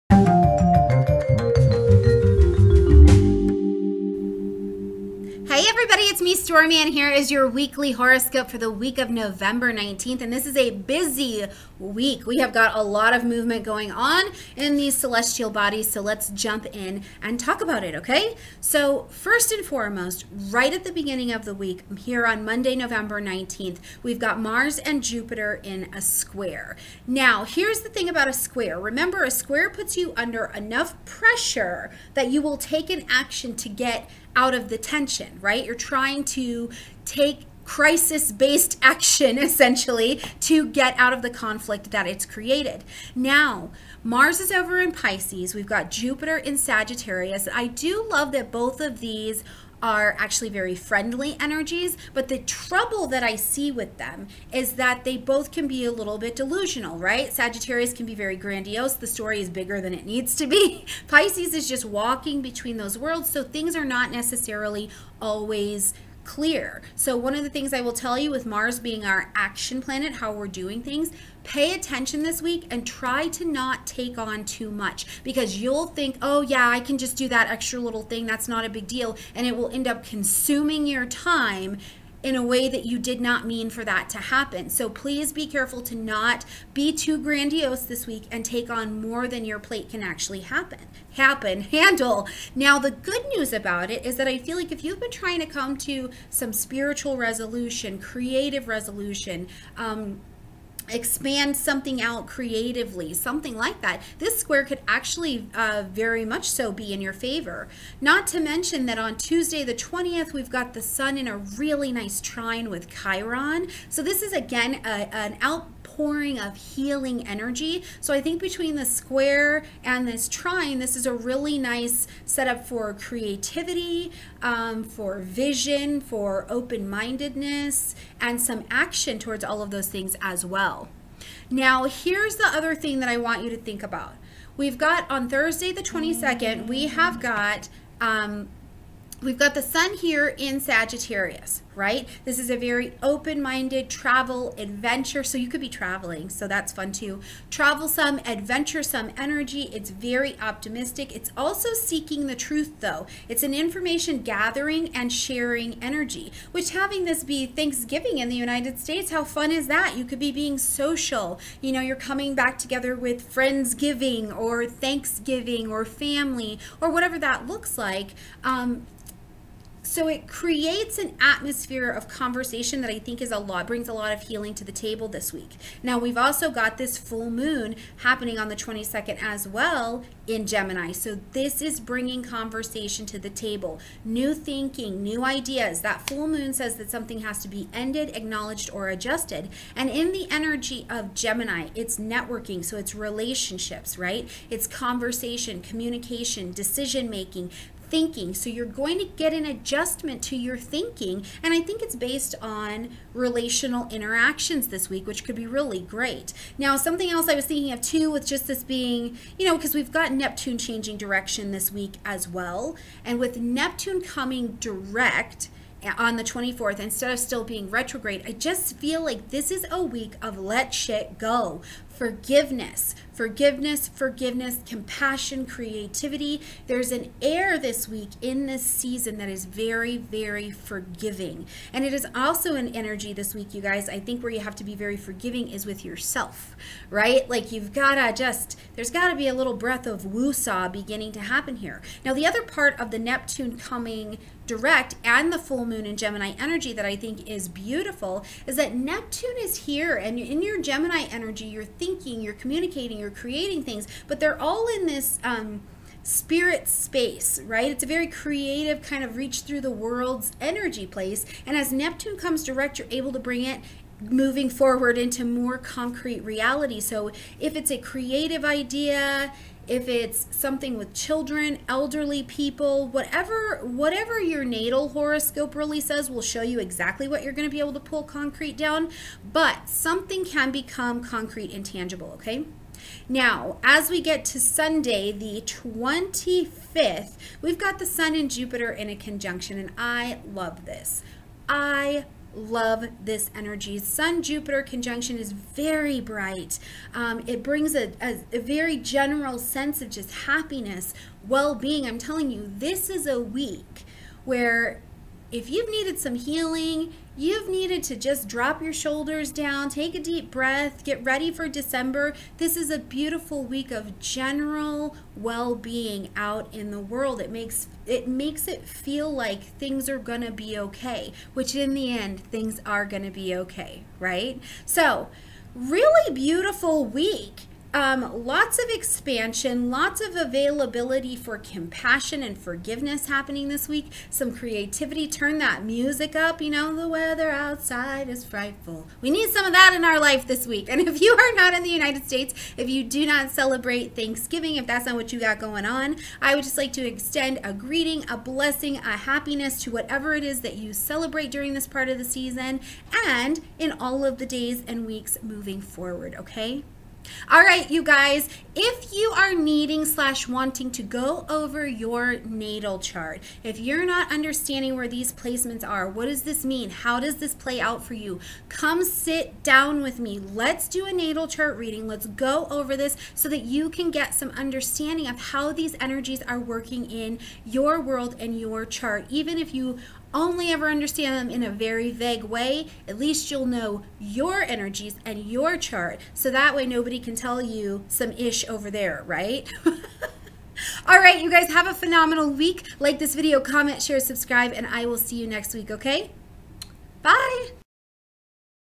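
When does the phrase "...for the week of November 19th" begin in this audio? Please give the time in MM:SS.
00:08.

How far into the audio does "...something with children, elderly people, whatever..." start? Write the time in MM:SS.
04:30.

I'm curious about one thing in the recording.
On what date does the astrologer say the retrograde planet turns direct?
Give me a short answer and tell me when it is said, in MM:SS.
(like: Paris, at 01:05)
24th, at 03:36.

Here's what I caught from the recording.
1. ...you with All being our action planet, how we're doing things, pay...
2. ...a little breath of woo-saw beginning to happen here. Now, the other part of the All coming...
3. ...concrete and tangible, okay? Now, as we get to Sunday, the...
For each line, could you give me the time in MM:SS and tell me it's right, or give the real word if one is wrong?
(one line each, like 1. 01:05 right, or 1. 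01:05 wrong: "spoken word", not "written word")
1. 01:08 wrong: "Mars", not "All"
2. 03:59 wrong: "Neptune", not "All"
3. 04:41 right.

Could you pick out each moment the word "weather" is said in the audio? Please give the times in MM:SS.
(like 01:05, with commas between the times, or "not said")
05:36.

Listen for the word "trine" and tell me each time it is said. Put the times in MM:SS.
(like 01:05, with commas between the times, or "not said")
01:52, 02:00.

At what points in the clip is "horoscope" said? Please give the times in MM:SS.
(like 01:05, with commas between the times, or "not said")
00:07, 04:34.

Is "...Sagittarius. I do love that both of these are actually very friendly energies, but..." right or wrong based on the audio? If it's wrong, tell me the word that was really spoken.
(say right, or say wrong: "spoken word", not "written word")
right.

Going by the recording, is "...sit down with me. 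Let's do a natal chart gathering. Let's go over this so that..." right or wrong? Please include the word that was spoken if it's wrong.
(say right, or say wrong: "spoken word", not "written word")
wrong: "reading", not "gathering".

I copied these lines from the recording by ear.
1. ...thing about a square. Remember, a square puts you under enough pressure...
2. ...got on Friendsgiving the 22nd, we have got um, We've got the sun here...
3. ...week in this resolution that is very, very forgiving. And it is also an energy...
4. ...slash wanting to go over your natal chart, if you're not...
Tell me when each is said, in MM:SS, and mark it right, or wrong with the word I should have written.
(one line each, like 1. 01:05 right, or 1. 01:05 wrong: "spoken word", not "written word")
1. 00:27 right
2. 02:14 wrong: "Thursday", not "Friendsgiving"
3. 03:47 wrong: "season", not "resolution"
4. 05:59 right.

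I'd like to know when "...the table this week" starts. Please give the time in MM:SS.
02:54.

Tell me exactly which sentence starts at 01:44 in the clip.
This square could actually uh, very much so be in your favor.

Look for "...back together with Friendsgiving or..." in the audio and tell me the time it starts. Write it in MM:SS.
02:42.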